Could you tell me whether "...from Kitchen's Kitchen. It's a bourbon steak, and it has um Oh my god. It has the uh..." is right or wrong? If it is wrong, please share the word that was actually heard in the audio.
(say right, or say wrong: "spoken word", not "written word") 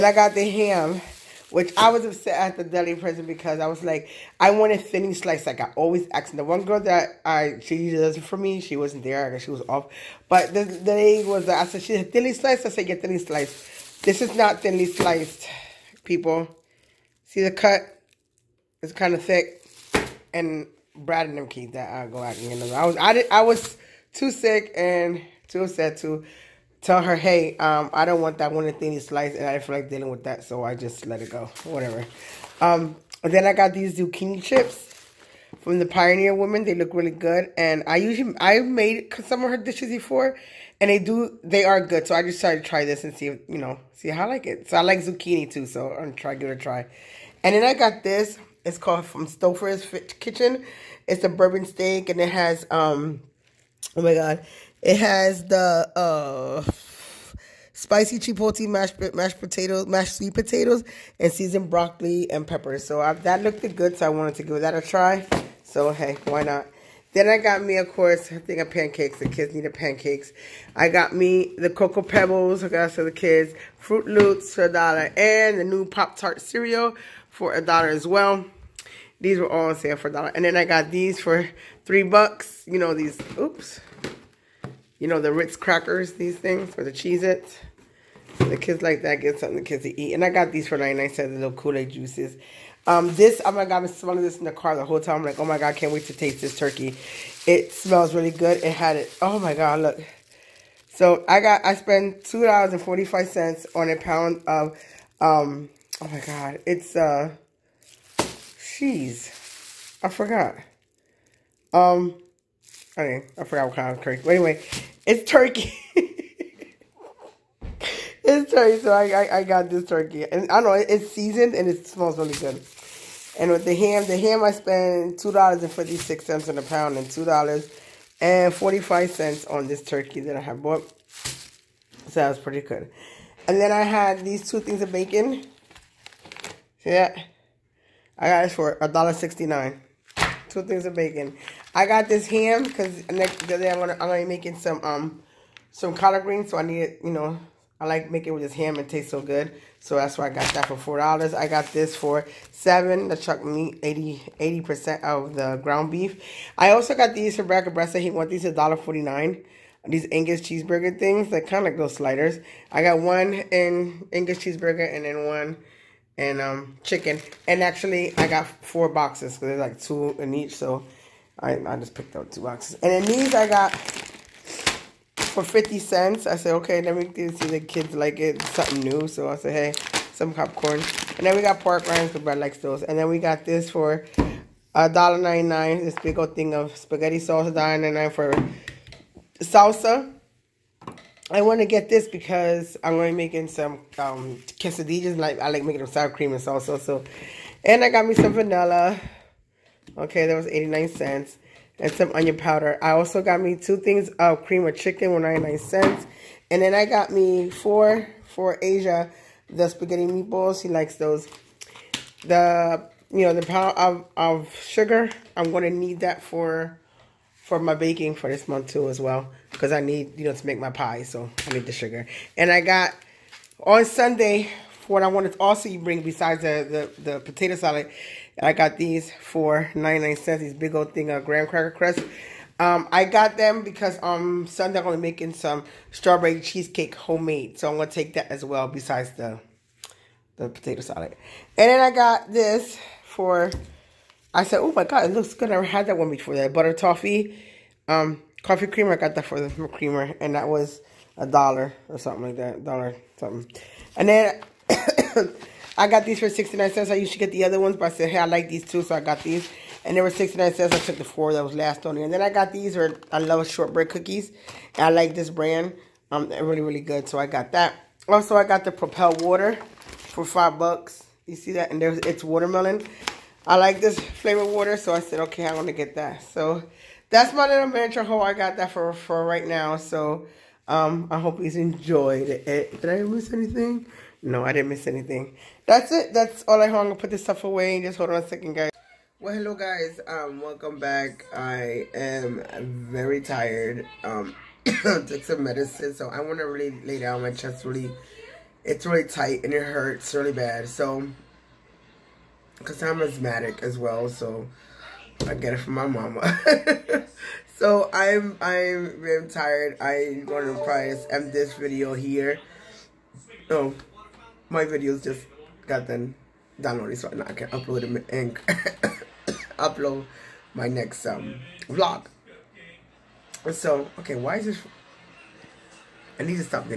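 wrong: "Stouffer", not "Kitchen".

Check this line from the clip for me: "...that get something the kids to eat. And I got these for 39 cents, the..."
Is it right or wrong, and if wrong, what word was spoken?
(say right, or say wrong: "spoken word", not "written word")
wrong: "99", not "39".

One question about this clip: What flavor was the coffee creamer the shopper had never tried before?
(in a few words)
butter toffee.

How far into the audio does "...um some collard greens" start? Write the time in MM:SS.
02:24.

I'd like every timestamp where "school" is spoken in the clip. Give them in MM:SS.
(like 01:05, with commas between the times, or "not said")
not said.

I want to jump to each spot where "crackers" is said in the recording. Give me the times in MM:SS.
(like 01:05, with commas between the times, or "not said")
01:25, 03:51.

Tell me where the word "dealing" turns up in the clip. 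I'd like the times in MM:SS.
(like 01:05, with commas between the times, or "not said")
00:29.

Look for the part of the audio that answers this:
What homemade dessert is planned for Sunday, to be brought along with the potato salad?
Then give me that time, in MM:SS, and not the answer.
03:55.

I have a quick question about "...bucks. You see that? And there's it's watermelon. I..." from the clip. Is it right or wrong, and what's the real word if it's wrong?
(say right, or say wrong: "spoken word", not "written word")
right.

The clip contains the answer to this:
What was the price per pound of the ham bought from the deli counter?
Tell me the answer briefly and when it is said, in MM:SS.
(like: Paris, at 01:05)
$2.56, at 02:05.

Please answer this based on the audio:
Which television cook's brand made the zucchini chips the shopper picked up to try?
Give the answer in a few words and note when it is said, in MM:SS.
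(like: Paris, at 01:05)
Pioneer Woman, at 00:35.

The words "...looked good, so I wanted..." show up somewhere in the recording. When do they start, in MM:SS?
01:03.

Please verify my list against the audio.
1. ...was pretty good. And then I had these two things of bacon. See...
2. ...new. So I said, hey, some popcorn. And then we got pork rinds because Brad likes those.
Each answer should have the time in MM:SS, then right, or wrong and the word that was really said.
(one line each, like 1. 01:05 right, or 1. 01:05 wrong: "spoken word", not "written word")
1. 02:12 right
2. 02:58 right.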